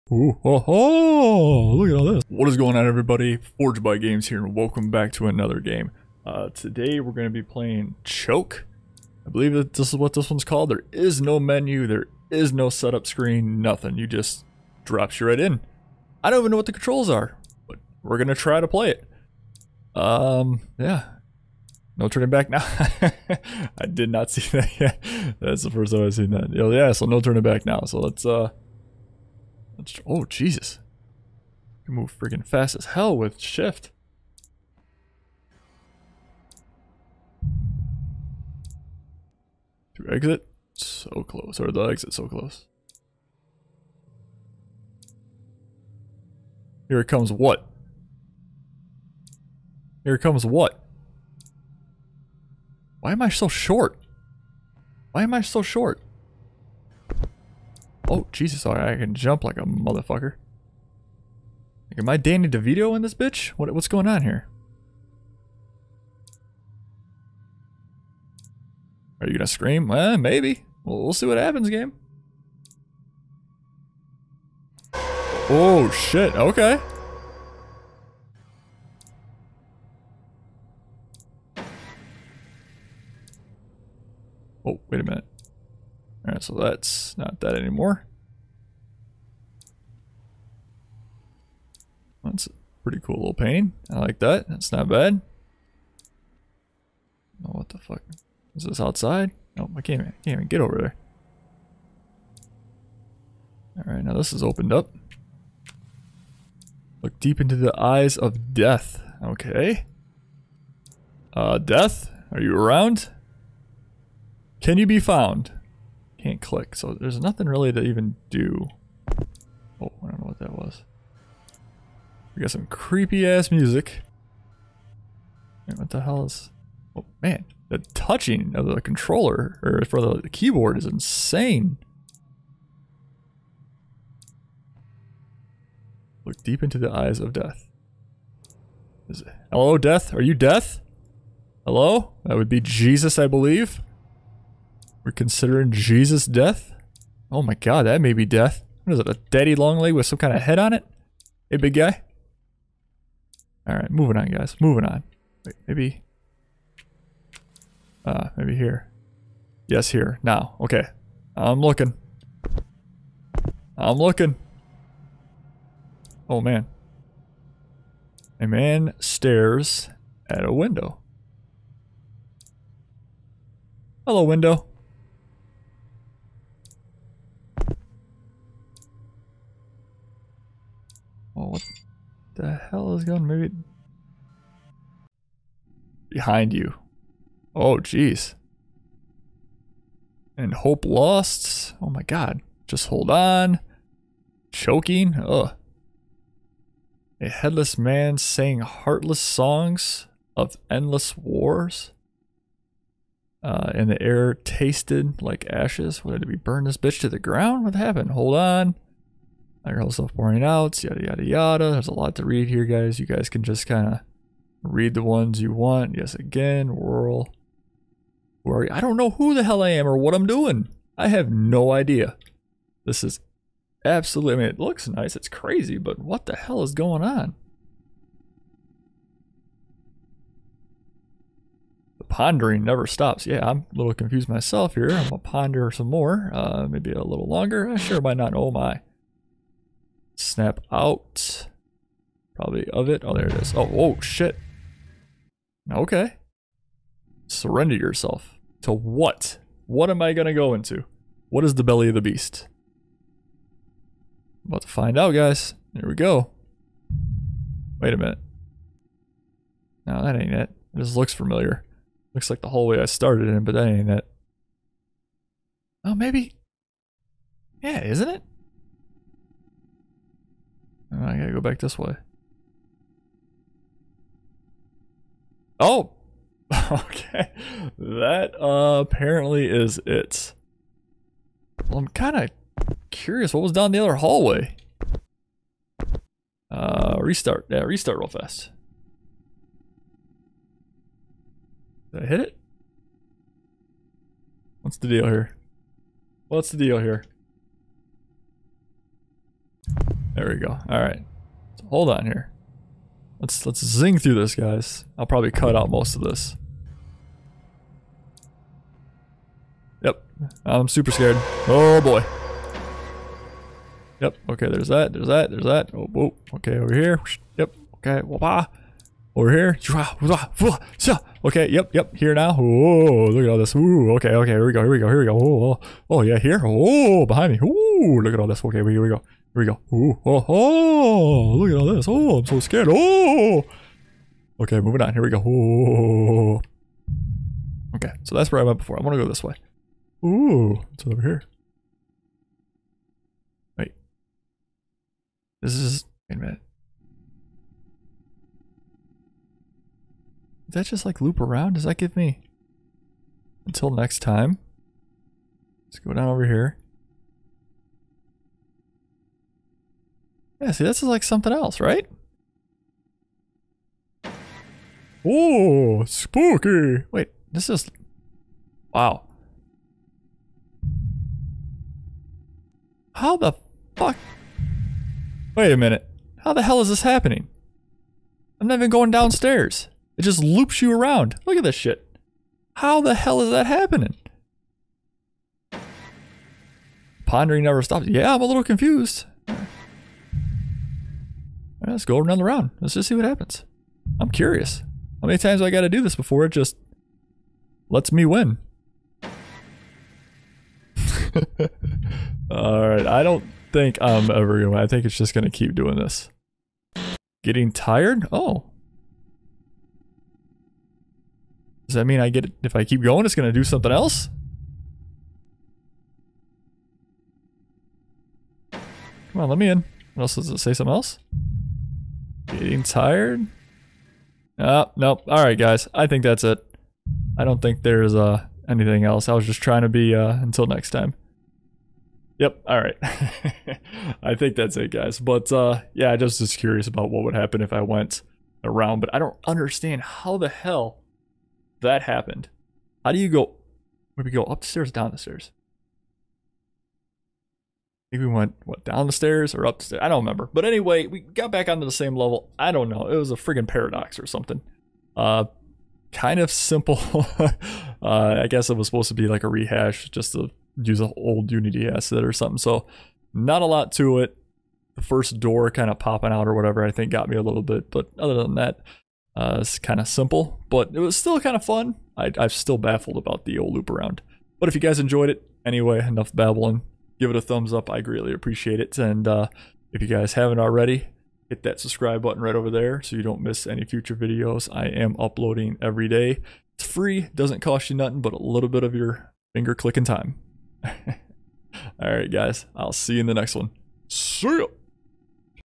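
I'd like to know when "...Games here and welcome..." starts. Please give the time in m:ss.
0:03.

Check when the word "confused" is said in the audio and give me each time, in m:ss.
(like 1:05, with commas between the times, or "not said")
3:53, 6:28.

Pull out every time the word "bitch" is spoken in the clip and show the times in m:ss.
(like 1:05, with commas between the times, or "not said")
1:03, 3:26.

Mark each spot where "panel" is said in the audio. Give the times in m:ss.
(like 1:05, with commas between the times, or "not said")
not said.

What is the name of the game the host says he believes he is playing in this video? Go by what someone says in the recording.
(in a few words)
Choke.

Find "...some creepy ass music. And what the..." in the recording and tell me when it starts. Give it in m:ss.
2:02.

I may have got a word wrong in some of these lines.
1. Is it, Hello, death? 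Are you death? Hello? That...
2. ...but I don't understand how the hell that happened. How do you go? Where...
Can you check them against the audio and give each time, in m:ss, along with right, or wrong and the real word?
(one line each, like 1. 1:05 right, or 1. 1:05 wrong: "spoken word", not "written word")
1. 2:19 right
2. 7:18 right.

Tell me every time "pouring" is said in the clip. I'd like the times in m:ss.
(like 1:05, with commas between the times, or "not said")
3:29.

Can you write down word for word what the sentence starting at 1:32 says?
That's a pretty cool little painting.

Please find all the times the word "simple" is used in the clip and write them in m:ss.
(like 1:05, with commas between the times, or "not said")
7:36, 7:49.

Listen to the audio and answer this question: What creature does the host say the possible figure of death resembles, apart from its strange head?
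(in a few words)
A daddy long leg.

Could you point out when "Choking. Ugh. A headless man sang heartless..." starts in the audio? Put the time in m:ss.
3:14.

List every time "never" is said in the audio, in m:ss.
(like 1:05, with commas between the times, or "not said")
3:52, 6:27.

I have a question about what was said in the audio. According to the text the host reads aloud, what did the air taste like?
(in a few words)
Ashes.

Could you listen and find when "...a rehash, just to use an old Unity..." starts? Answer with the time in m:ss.
7:39.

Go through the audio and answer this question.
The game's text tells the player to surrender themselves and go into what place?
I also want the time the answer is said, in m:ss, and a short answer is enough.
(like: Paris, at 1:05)
The belly of the beast, at 4:11.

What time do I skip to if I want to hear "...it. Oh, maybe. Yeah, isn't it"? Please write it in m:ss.
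4:23.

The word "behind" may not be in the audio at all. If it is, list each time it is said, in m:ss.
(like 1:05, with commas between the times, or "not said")
3:06, 5:27.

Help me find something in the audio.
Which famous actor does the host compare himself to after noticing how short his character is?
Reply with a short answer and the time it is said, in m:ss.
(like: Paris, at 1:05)
Danny DeVito, at 1:02.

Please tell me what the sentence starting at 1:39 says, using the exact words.
Oh, I can't, even, I can't even get over there.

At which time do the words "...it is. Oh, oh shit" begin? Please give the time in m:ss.
4:03.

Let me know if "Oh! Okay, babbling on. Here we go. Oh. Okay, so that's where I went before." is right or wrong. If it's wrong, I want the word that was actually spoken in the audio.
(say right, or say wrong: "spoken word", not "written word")
wrong: "moving", not "babbling".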